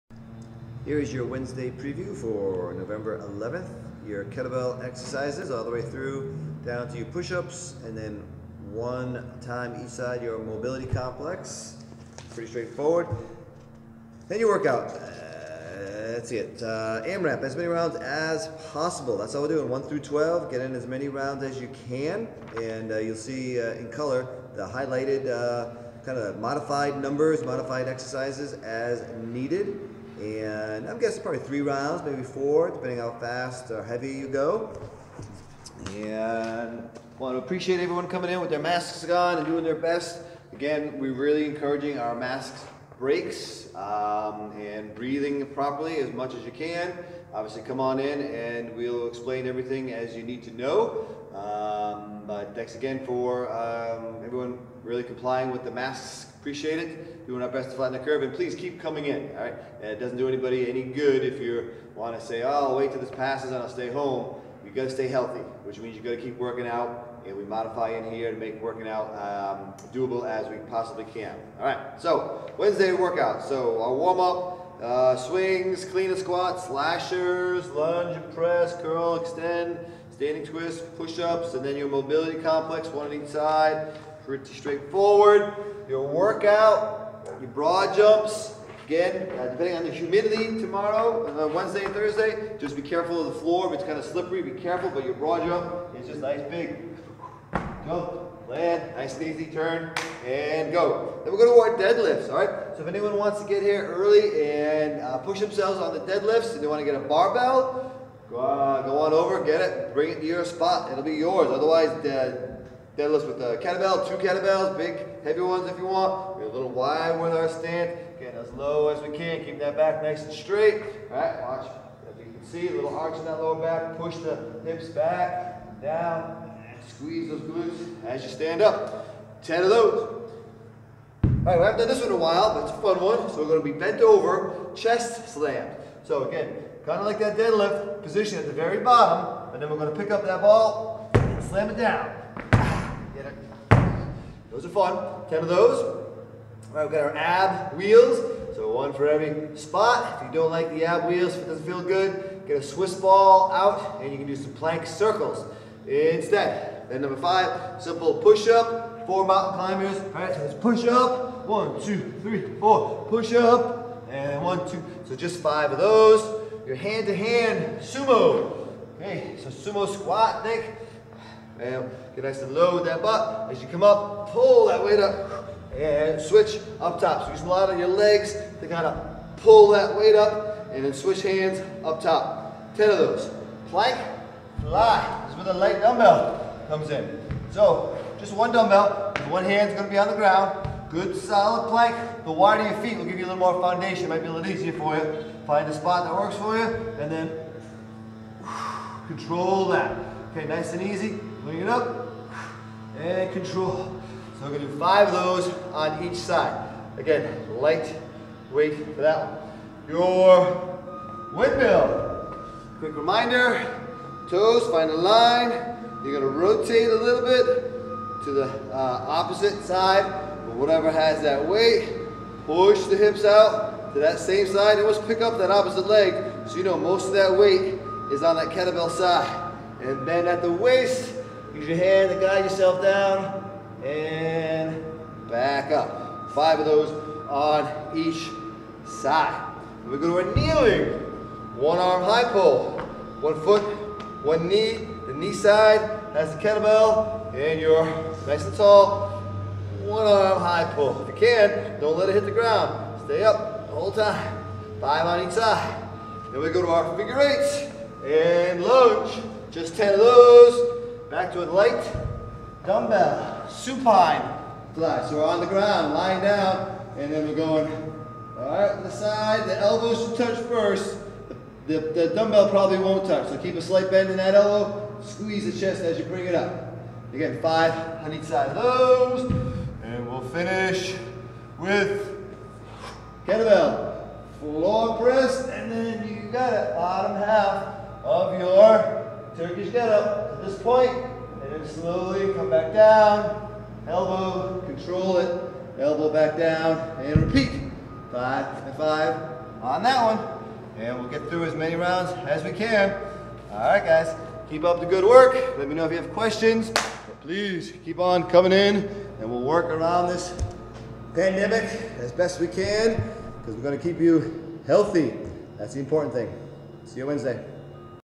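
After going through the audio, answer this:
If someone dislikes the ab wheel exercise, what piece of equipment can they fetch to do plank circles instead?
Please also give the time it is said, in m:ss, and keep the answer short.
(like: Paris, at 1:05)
Swiss ball, at 2:32.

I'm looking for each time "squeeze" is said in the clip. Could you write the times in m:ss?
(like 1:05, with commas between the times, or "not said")
2:06, 4:35.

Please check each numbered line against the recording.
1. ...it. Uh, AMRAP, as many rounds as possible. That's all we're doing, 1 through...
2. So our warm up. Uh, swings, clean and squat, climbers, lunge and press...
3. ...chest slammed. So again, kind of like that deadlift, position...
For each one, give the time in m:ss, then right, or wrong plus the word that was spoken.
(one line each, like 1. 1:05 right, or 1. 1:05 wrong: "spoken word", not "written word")
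1. 0:16 right
2. 1:13 wrong: "slashers", not "climbers"
3. 2:14 right.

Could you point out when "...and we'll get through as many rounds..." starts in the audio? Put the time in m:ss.
5:00.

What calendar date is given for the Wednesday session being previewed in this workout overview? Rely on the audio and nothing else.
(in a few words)
November 11th.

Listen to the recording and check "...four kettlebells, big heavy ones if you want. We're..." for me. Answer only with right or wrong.
wrong.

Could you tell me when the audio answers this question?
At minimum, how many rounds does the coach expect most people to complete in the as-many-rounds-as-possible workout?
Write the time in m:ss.
0:31.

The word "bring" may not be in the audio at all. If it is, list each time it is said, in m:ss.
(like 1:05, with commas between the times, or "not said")
1:49, 3:21, 4:36.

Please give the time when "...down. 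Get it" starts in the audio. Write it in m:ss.
2:21.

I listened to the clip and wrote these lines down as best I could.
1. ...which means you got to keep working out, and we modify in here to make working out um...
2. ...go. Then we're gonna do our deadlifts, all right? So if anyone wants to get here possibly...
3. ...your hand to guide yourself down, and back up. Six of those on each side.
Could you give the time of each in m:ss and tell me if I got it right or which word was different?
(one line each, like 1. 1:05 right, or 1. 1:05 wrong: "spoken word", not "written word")
1. 1:05 right
2. 1:40 wrong: "early", not "possibly"
3. 3:51 wrong: "Five", not "Six".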